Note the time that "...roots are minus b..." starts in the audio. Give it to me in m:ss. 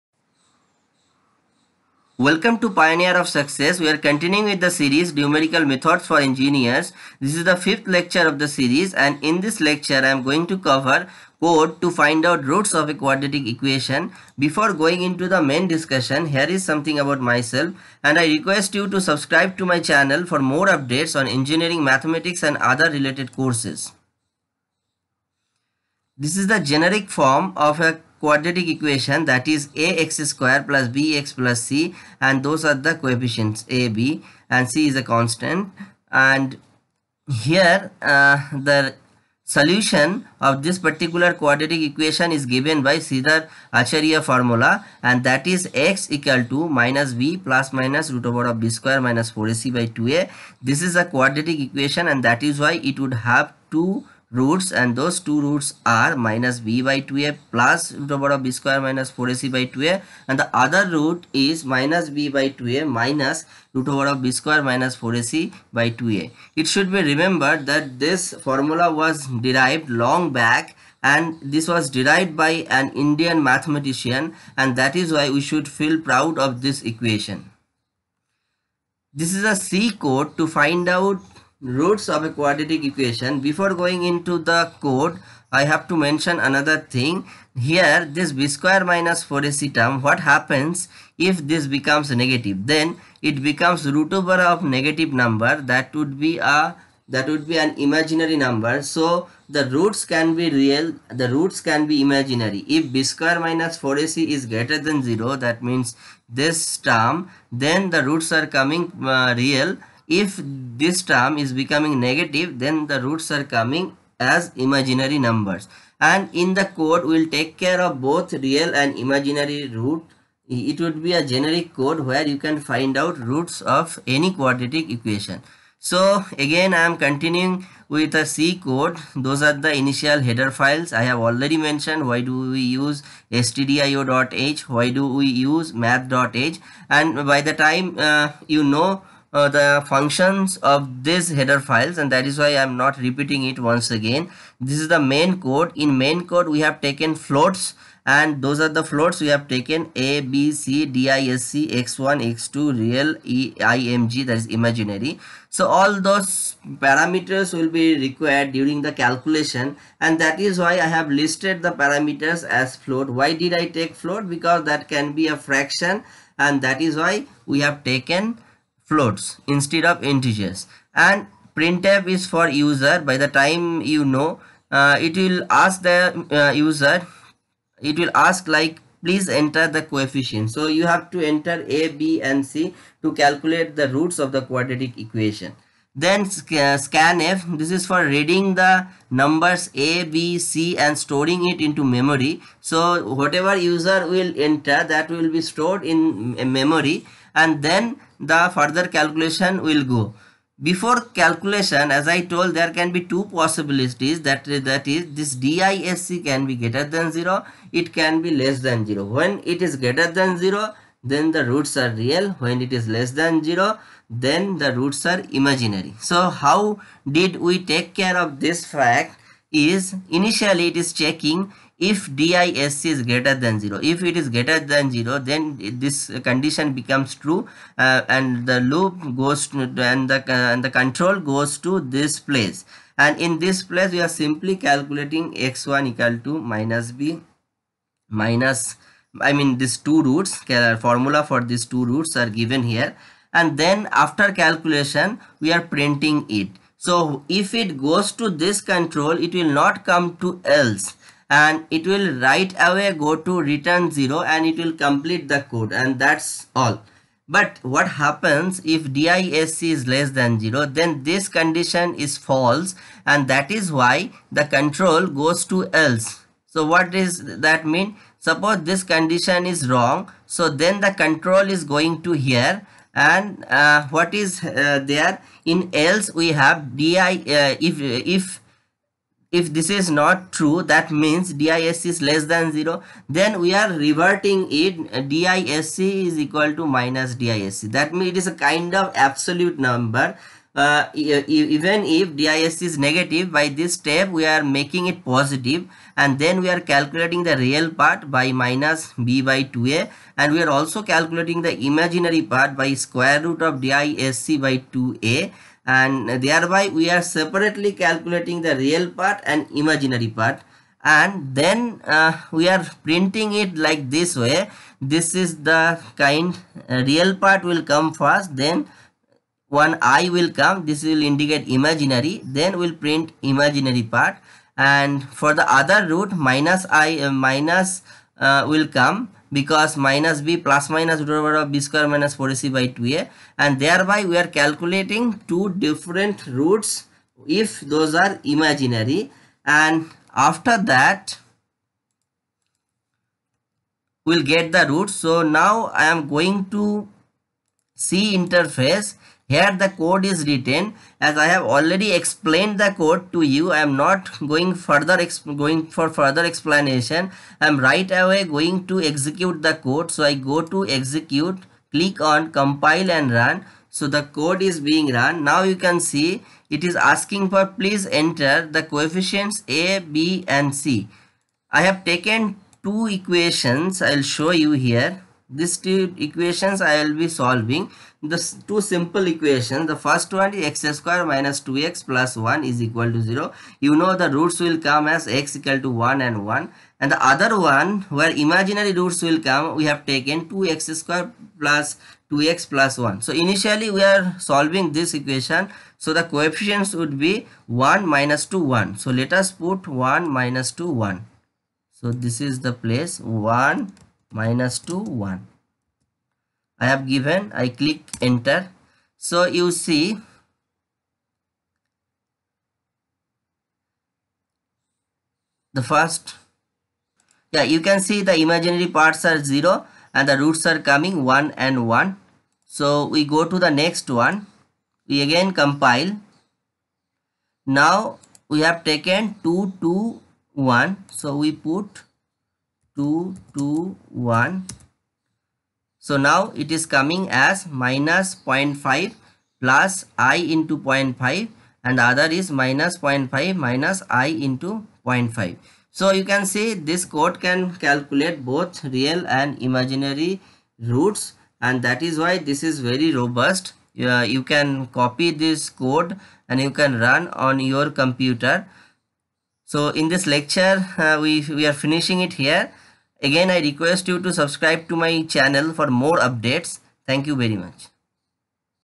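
0:55.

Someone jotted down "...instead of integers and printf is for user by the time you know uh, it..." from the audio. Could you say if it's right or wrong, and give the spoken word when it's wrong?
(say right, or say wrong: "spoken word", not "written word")
right.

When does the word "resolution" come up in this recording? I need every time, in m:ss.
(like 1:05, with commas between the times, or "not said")
not said.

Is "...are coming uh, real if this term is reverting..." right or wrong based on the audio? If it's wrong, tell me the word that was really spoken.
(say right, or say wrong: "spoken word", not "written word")
wrong: "becoming", not "reverting".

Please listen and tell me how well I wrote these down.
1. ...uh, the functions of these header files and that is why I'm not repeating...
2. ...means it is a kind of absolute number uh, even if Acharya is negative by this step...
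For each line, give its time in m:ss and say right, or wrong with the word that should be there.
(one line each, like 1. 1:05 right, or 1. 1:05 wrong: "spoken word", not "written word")
1. 2:19 right
2. 4:47 wrong: "DISC", not "Acharya".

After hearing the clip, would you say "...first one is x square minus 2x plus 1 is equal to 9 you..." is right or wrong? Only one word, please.
wrong.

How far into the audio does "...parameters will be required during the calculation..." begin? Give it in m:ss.
2:36.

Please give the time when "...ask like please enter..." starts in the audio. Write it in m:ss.
2:58.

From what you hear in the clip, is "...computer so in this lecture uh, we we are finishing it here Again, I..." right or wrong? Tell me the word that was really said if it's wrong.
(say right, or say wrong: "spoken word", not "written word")
right.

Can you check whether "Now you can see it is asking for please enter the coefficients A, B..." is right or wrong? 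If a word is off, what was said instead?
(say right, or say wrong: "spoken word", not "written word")
right.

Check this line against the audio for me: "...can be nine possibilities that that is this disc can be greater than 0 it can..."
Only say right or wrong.
wrong.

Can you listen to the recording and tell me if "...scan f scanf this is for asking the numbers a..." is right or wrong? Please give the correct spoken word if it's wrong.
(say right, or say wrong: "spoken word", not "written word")
wrong: "reading", not "asking".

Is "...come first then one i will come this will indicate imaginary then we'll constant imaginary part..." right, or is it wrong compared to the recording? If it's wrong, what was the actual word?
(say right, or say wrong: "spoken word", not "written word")
wrong: "print", not "constant".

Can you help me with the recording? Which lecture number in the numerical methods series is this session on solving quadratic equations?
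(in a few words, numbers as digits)
Fifth.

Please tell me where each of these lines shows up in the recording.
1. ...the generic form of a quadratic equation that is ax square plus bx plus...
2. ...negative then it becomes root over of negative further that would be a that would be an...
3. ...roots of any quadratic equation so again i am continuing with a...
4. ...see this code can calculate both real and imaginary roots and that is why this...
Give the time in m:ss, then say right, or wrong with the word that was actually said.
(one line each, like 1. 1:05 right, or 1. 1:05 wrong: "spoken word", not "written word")
1. 0:26 right
2. 1:32 wrong: "number", not "further"
3. 2:03 right
4. 7:26 right.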